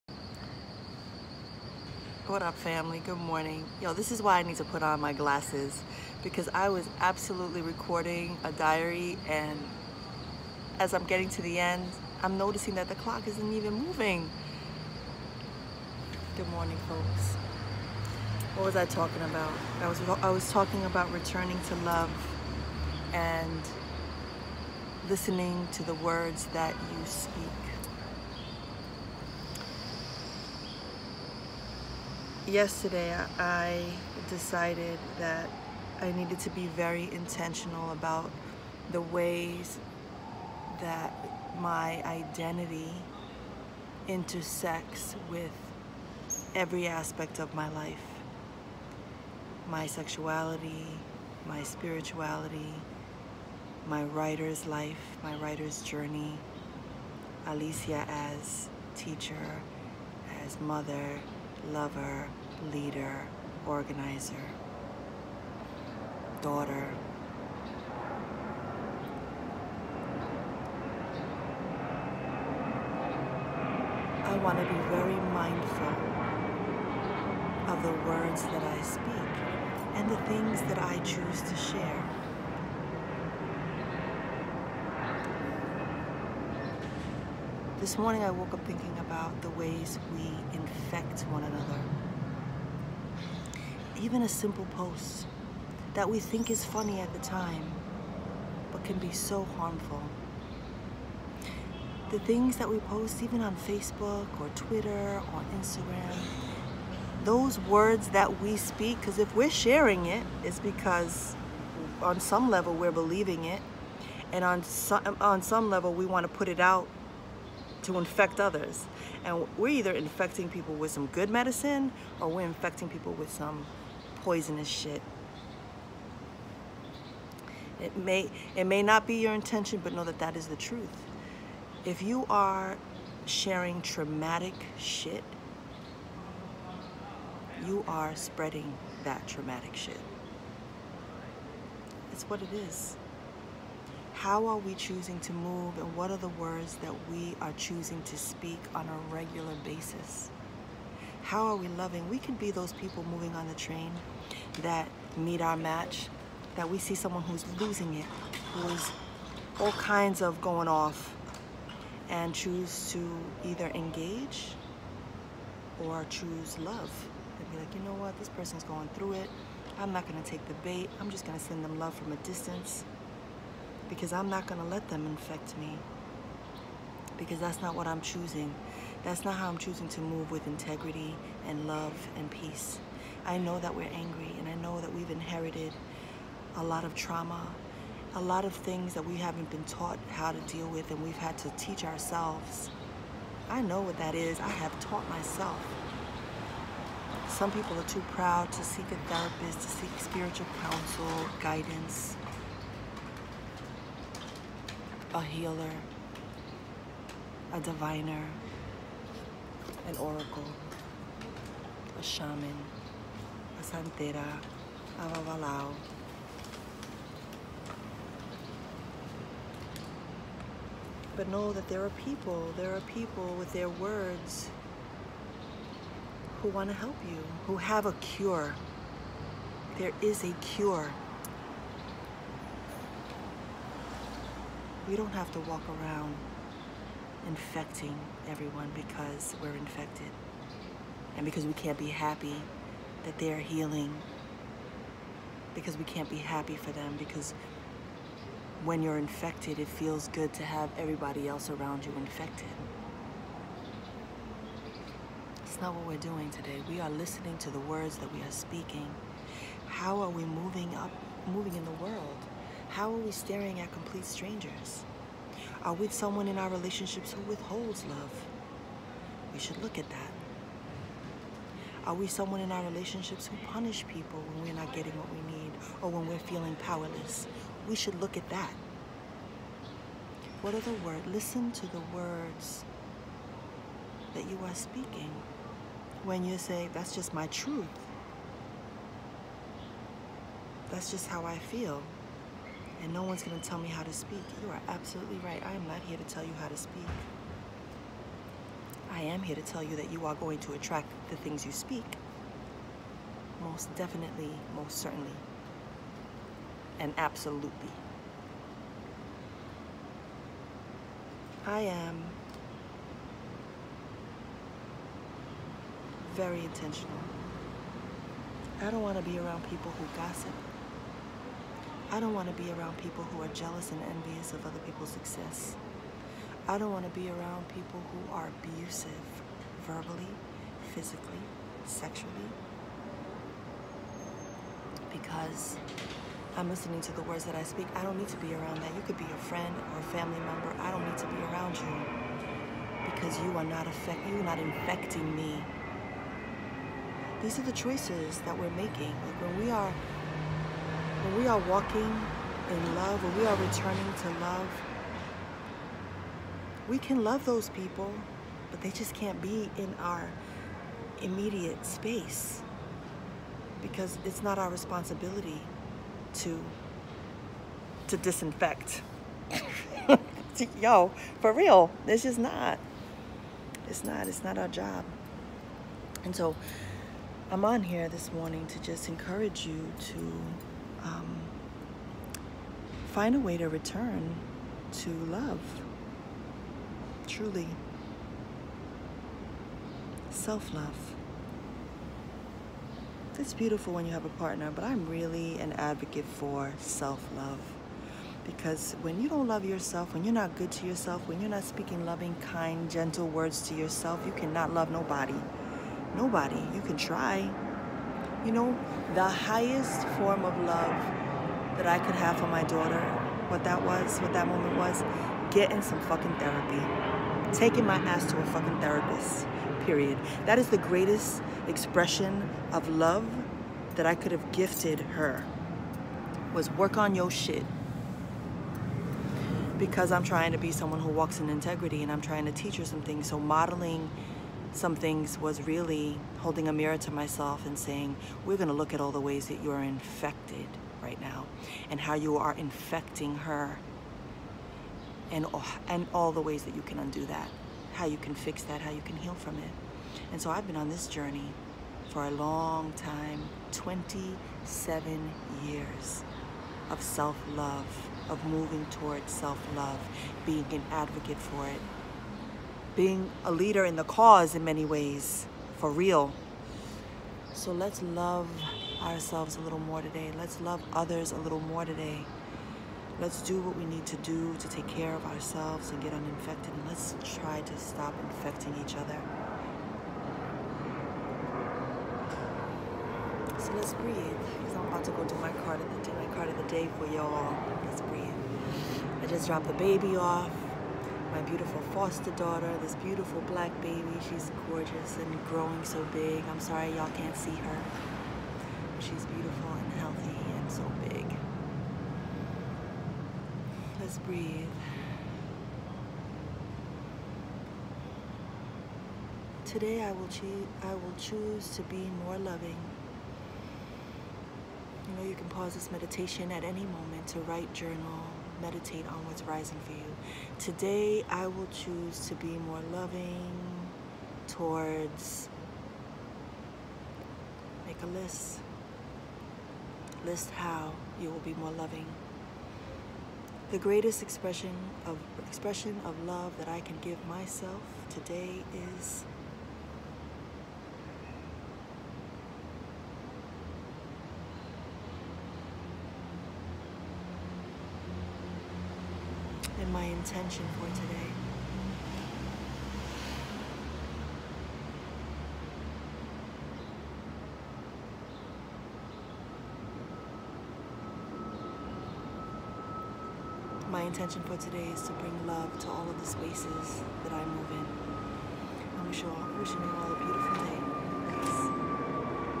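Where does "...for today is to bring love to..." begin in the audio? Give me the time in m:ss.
9:24.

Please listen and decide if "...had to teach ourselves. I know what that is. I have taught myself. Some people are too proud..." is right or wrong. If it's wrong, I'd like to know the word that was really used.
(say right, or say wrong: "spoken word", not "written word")
right.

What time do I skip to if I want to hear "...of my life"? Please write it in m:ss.
0:47.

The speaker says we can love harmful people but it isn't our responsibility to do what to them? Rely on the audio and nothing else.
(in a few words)
Disinfect.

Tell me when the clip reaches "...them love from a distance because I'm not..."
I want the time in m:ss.
2:51.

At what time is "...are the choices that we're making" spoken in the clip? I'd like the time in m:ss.
5:47.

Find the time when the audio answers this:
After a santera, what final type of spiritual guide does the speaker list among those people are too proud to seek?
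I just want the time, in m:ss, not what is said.
3:35.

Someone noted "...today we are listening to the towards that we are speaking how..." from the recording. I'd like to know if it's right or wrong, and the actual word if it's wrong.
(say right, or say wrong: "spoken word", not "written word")
wrong: "words", not "towards".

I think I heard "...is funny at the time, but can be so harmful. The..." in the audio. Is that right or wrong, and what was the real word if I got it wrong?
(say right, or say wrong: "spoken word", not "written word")
right.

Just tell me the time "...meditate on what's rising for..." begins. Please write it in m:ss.
8:38.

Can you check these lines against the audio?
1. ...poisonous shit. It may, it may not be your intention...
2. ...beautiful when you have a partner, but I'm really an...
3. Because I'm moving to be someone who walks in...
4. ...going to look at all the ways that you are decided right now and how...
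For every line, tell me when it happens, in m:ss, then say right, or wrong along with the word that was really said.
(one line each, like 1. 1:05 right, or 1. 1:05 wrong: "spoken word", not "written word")
1. 2:04 right
2. 6:33 right
3. 7:09 wrong: "trying", not "moving"
4. 7:18 wrong: "infected", not "decided".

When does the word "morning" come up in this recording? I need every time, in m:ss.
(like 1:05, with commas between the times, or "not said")
0:03, 0:16, 1:27, 6:18.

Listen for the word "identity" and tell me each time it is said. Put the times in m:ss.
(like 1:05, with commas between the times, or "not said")
0:42.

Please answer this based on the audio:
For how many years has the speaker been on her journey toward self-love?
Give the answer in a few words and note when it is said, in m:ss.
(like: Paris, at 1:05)
27 years, at 7:33.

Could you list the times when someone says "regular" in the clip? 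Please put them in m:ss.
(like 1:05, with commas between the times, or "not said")
2:29.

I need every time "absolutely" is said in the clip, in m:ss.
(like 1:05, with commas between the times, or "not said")
0:07, 4:54, 5:06.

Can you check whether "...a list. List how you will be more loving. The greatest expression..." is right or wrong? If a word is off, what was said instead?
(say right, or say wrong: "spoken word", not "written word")
right.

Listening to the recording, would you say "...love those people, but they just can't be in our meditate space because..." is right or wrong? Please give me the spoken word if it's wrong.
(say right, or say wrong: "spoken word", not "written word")
wrong: "immediate", not "meditate".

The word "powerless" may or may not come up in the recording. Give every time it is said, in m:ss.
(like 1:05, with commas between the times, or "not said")
4:36.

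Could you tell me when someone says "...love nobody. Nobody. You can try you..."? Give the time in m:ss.
6:44.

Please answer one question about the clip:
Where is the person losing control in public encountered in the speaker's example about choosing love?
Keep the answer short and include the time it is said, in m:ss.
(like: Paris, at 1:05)
On the train, at 2:33.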